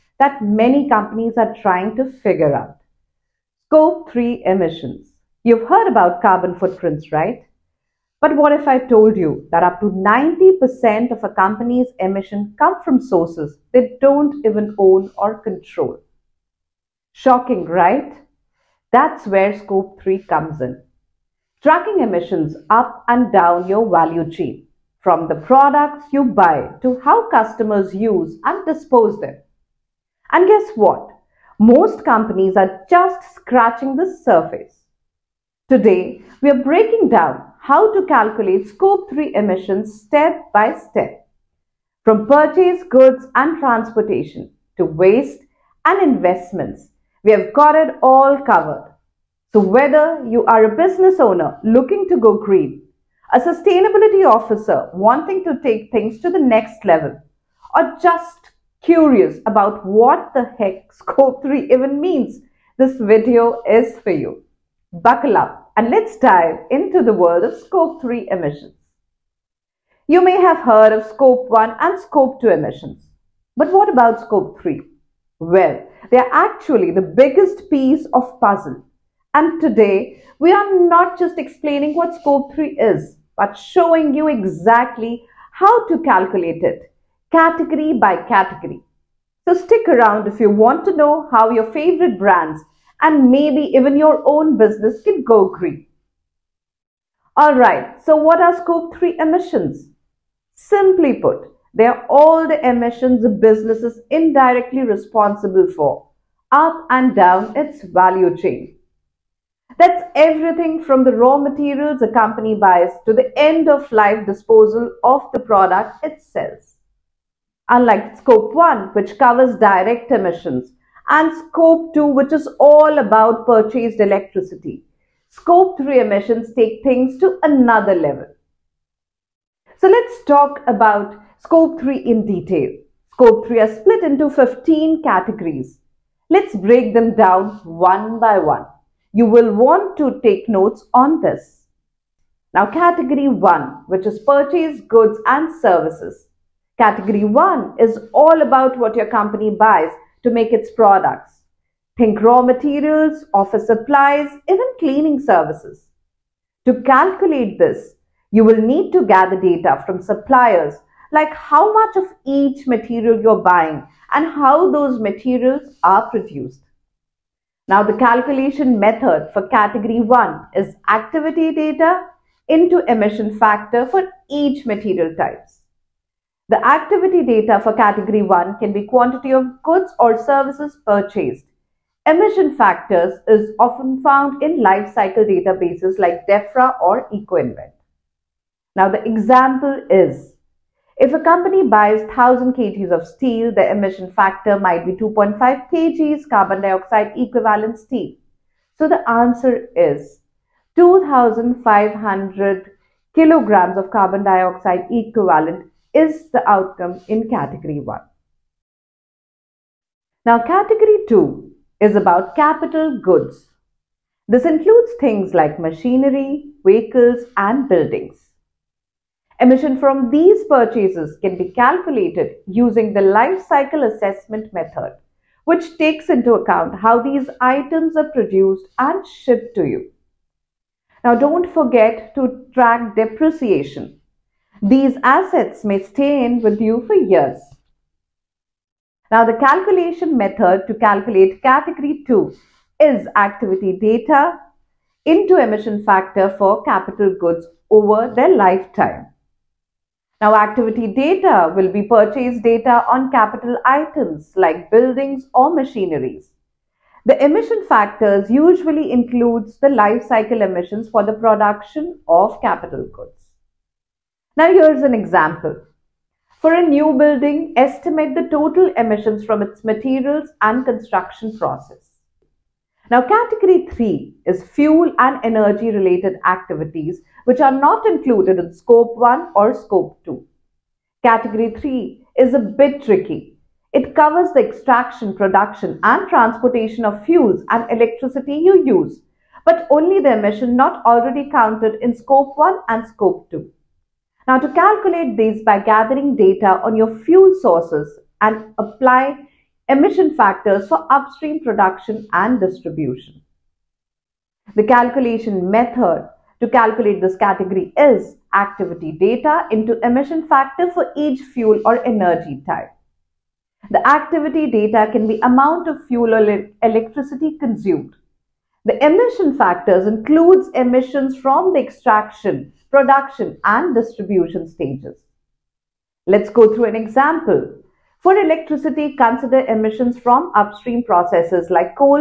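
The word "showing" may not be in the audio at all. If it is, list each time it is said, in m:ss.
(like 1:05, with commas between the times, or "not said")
1:23.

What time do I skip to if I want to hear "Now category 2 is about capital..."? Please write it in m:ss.
3:30.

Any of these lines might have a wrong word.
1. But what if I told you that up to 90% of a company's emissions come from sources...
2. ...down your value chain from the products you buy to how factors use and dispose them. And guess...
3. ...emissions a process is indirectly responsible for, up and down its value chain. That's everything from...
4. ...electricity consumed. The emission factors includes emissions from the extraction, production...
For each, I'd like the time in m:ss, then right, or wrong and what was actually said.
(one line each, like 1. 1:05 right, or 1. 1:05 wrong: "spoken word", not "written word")
1. 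0:08 right
2. 0:23 wrong: "customers", not "factors"
3. 1:42 wrong: "business", not "process"
4. 5:16 right.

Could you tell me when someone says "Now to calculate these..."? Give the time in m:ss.
4:54.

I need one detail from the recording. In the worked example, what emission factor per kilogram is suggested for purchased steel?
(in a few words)
2.5 kg CO2e.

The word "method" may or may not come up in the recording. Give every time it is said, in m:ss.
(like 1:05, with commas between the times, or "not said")
2:48, 3:44, 4:00, 5:05.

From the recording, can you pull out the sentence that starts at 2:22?
Now category 1 which is purchase goods and services.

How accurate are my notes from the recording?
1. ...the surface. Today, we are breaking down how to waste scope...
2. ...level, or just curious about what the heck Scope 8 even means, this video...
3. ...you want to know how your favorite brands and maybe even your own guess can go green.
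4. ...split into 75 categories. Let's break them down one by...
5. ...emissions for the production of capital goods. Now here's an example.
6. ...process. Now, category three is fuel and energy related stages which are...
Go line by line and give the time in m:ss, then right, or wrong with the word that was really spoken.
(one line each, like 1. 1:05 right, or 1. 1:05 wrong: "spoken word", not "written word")
1. 0:33 wrong: "calculate", not "waste"
2. 0:56 wrong: "3", not "8"
3. 1:30 wrong: "business", not "guess"
4. 2:13 wrong: "15", not "75"
5. 4:20 right
6. 4:31 wrong: "activities", not "stages".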